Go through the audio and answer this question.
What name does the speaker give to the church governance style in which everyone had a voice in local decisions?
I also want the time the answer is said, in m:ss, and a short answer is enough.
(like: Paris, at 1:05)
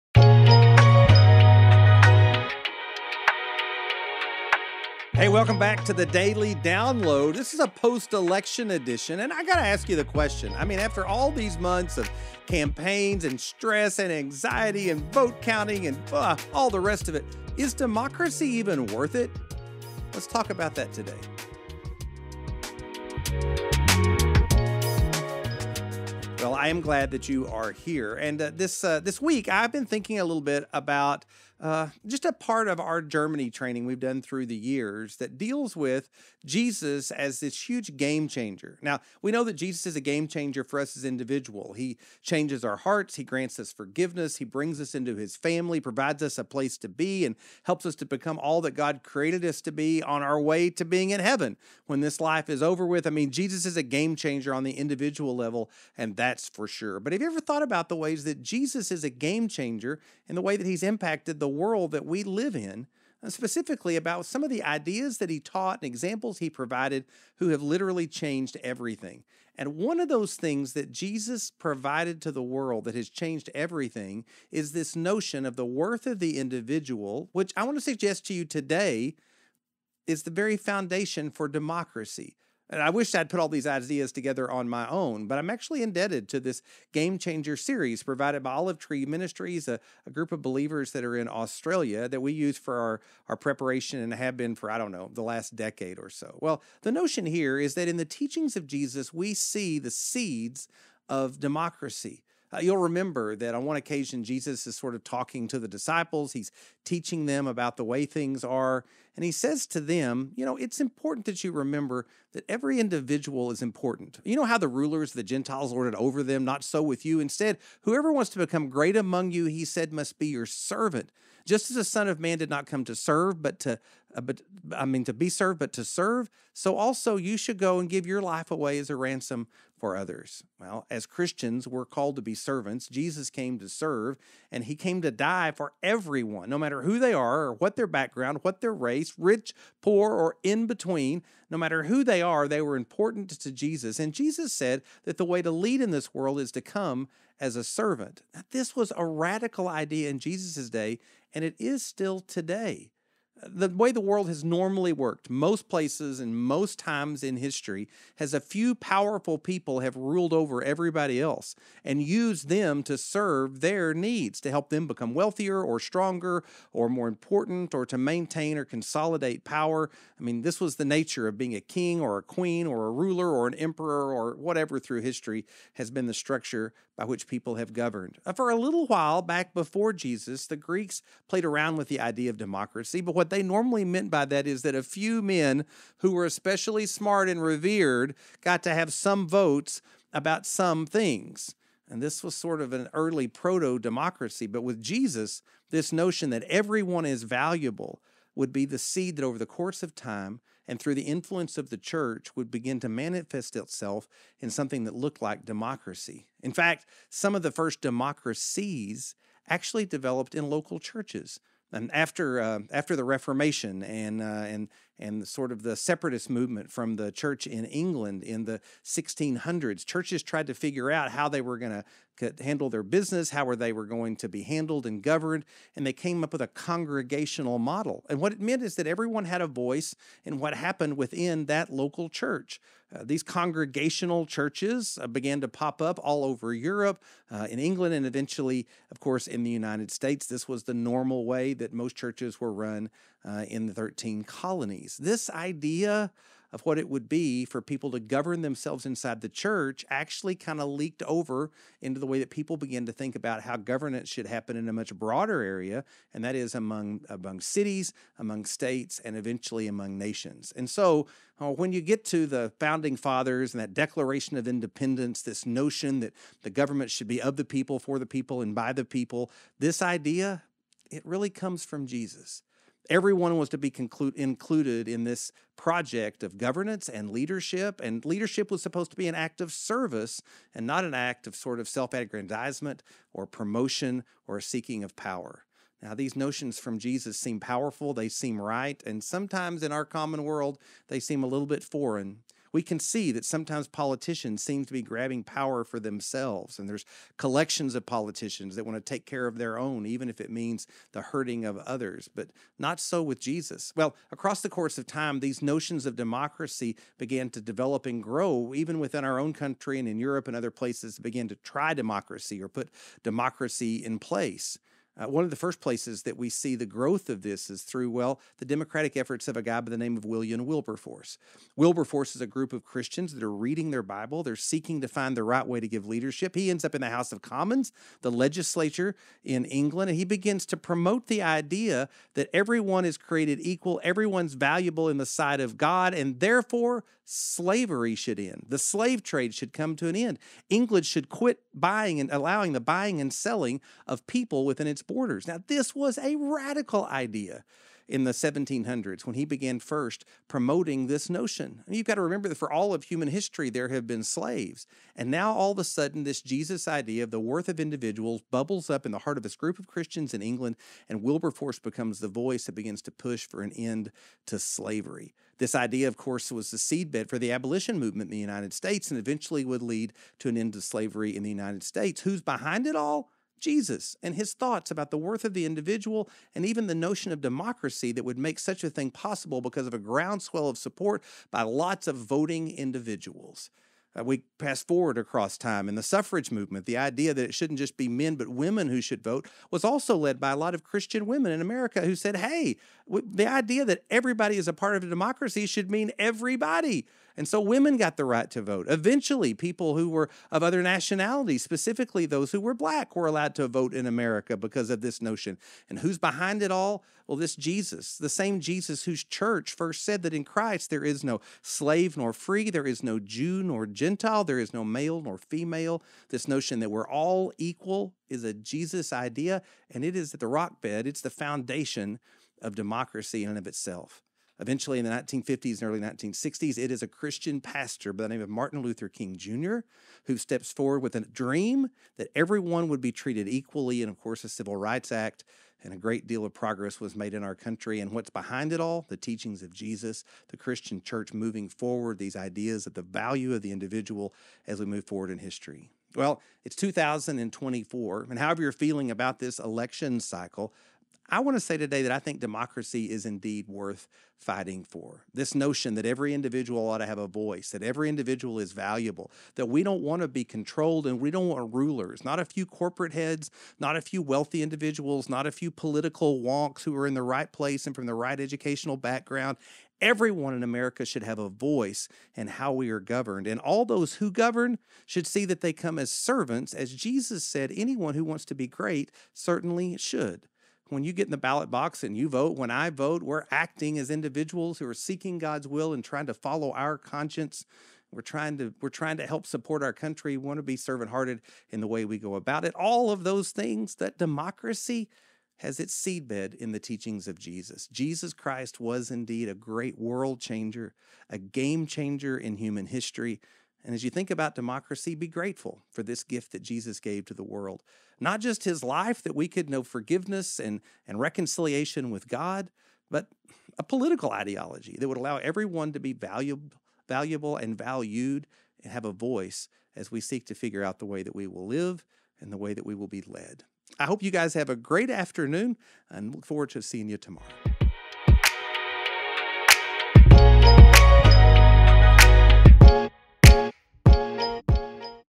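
congregational model, at 3:46.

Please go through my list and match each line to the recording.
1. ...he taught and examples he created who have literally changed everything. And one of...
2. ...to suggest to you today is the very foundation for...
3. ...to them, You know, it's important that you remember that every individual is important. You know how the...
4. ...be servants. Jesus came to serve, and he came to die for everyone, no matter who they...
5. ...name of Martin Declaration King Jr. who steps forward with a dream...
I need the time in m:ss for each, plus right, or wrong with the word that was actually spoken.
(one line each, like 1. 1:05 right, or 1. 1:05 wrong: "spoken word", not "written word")
1. 1:05 wrong: "provided", not "created"
2. 1:17 right
3. 1:49 right
4. 2:12 right
5. 7:08 wrong: "Luther", not "Declaration".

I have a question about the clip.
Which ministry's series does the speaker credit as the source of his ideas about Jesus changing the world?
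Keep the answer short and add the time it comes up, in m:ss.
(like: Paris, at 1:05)
Olive Tree Ministries, at 1:28.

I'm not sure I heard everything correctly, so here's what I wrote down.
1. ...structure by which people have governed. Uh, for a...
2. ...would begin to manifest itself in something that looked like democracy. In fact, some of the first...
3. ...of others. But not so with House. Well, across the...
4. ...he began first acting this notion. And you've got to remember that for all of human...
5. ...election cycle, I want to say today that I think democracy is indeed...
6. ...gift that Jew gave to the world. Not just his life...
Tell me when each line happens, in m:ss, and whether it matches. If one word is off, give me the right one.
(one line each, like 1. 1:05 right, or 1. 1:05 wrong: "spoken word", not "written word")
1. 2:56 right
2. 3:22 right
3. 5:01 wrong: "Jesus", not "House"
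4. 5:49 wrong: "promoting", not "acting"
5. 7:29 right
6. 8:26 wrong: "Jesus", not "Jew".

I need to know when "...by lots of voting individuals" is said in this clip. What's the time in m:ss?
6:21.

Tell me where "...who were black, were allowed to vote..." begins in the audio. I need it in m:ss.
6:42.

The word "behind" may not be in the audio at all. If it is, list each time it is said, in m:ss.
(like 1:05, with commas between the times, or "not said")
6:12, 6:45, 7:18.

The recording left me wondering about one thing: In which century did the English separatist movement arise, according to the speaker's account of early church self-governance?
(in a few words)
1600s.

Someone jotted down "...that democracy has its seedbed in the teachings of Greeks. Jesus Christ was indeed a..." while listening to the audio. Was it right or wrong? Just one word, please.
wrong.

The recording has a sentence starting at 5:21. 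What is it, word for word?
Wilberforce is a group of Christians that are reading their Bible.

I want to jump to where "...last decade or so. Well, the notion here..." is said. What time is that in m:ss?
1:35.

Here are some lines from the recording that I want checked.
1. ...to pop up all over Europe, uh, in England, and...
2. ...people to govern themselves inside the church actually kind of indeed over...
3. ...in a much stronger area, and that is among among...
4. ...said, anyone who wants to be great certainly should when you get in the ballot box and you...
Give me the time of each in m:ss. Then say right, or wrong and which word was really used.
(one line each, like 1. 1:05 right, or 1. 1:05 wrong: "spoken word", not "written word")
1. 3:55 right
2. 4:07 wrong: "leaked", not "indeed"
3. 4:14 wrong: "broader", not "stronger"
4. 7:57 right.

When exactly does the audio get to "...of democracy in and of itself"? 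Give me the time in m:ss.
7:02.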